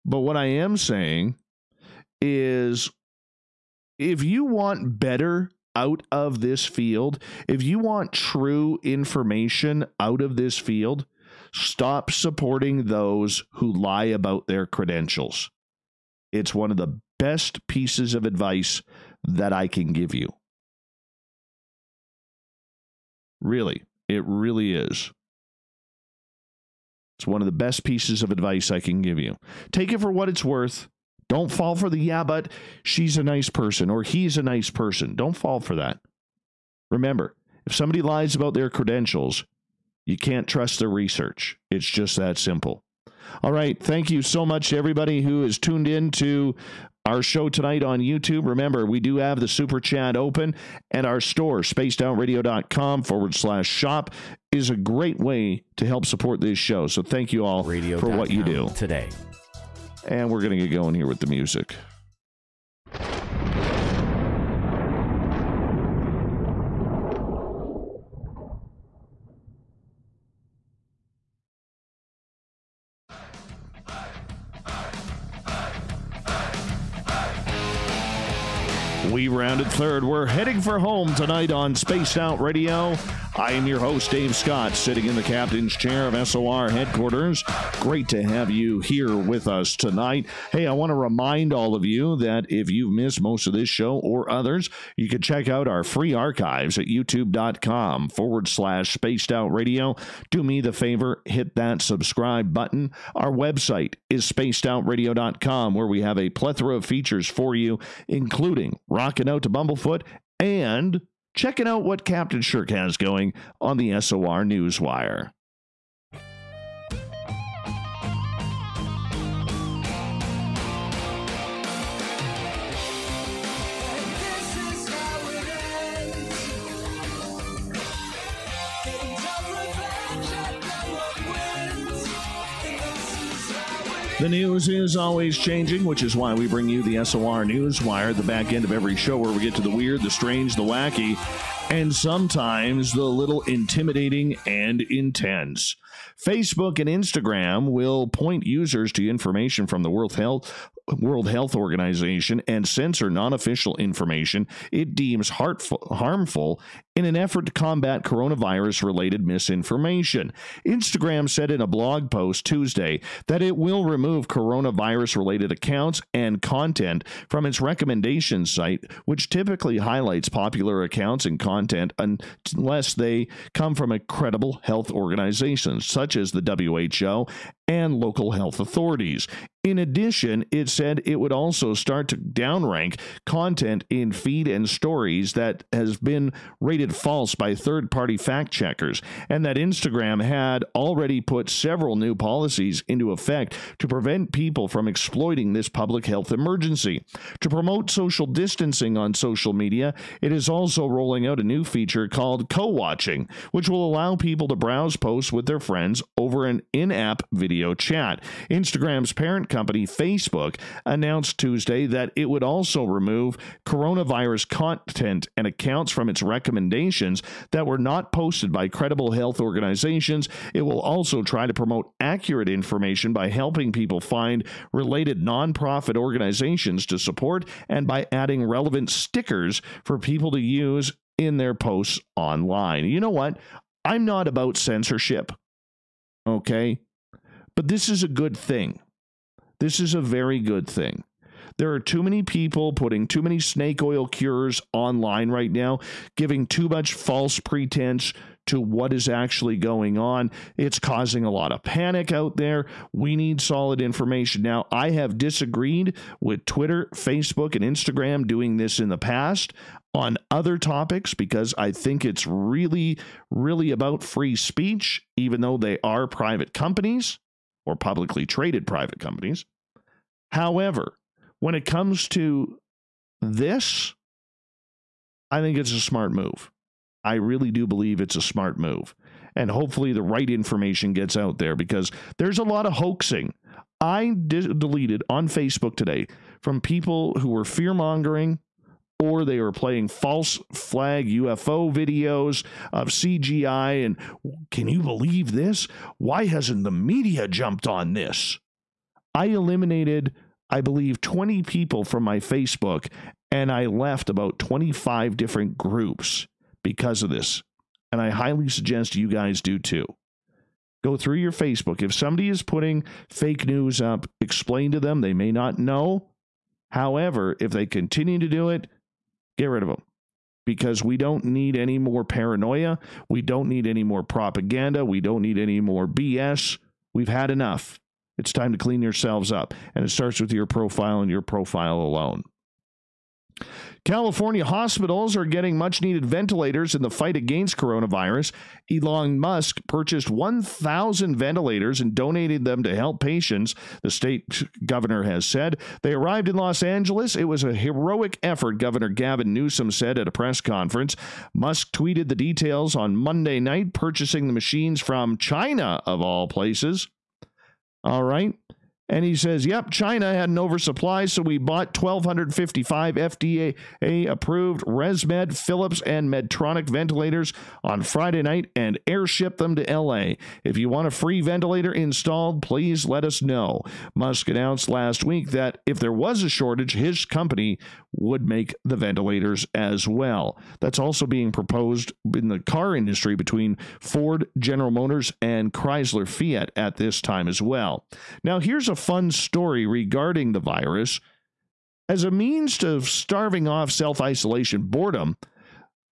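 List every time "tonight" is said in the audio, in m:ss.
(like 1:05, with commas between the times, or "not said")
0:47, 1:21, 1:29.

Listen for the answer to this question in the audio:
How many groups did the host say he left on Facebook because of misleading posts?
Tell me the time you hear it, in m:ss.
5:04.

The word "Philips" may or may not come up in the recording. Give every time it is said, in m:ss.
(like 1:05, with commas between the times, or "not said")
6:05.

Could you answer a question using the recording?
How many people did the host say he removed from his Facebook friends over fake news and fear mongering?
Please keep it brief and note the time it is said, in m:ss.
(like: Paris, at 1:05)
20, at 5:01.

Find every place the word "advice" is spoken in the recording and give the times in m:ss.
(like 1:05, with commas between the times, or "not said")
0:18, 0:28.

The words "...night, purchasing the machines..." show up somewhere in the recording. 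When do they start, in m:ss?
5:53.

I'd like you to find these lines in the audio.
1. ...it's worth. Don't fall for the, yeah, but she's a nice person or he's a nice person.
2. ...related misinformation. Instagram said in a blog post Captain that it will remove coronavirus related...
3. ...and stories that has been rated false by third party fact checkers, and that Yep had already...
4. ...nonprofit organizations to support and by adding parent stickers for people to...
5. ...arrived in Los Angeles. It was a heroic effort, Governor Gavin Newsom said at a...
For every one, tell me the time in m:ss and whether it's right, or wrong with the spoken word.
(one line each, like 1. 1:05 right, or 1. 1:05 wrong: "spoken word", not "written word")
1. 0:30 right
2. 2:38 wrong: "Tuesday", not "Captain"
3. 3:04 wrong: "Instagram", not "Yep"
4. 3:45 wrong: "relevant", not "parent"
5. 5:45 right.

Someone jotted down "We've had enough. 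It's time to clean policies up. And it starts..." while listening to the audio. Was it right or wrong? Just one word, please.
wrong.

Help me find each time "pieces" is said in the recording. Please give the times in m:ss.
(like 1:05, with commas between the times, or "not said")
0:17, 0:27.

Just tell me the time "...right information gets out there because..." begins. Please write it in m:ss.
4:40.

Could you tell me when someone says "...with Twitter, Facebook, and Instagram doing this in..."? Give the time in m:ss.
4:16.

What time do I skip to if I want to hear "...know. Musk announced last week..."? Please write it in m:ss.
6:13.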